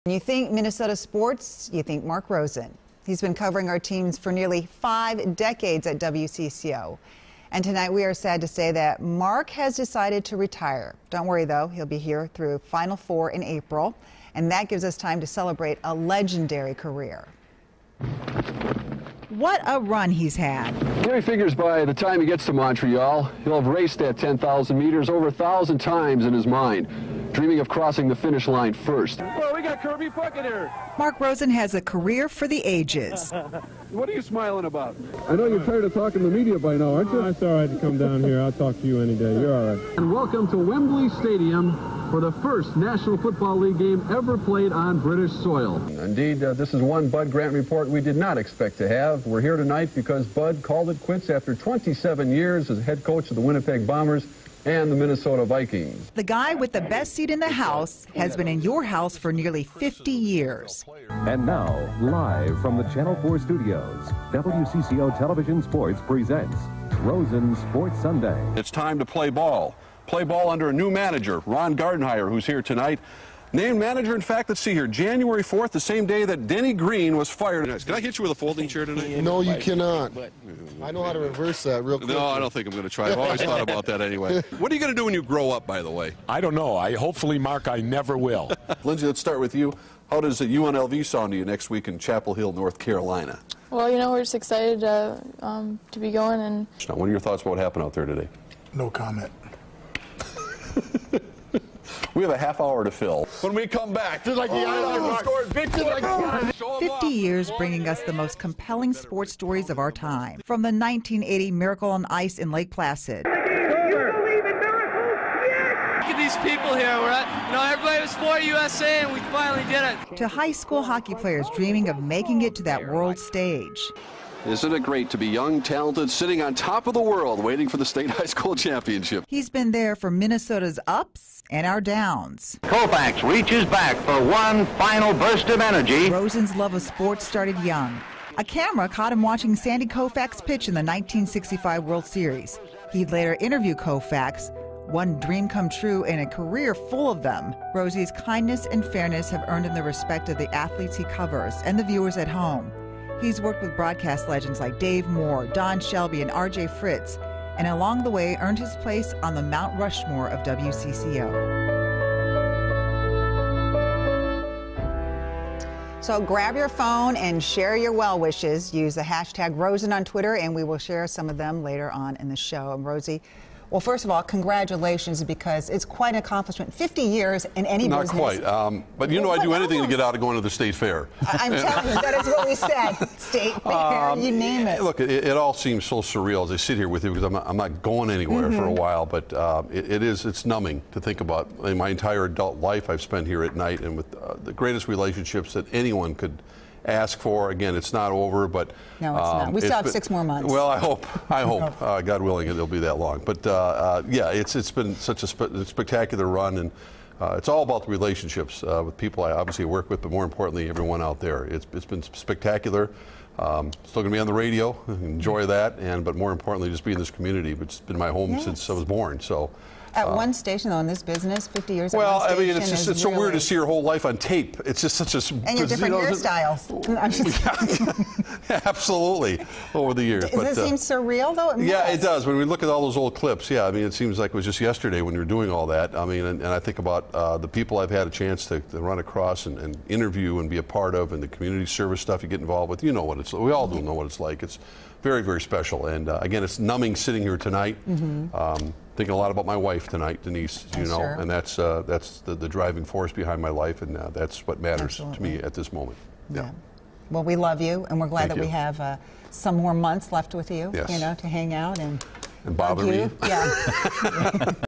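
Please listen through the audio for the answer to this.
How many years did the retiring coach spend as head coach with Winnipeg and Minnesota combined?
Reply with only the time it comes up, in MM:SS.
00:51.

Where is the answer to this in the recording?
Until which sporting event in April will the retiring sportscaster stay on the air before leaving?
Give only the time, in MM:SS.
00:12.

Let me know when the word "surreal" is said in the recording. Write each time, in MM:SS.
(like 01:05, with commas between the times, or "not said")
03:06, 03:50.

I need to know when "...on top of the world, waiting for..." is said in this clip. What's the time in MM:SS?
02:06.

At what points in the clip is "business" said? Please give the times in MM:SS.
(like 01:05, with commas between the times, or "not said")
02:58, 03:41.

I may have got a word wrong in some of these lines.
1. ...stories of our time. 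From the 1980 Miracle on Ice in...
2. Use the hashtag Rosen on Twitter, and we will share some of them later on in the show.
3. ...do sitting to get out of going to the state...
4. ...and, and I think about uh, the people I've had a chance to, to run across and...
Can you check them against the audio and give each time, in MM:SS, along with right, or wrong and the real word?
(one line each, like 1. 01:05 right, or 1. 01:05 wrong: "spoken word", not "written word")
1. 01:49 right
2. 02:48 right
3. 02:59 wrong: "anything", not "sitting"
4. 03:56 right.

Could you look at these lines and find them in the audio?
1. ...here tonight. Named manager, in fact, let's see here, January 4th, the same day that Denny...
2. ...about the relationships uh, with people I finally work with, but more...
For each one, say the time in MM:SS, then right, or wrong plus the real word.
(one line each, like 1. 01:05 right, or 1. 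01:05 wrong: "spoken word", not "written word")
1. 01:12 right
2. 03:27 wrong: "obviously", not "finally".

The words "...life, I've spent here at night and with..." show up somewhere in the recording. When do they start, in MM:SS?
03:12.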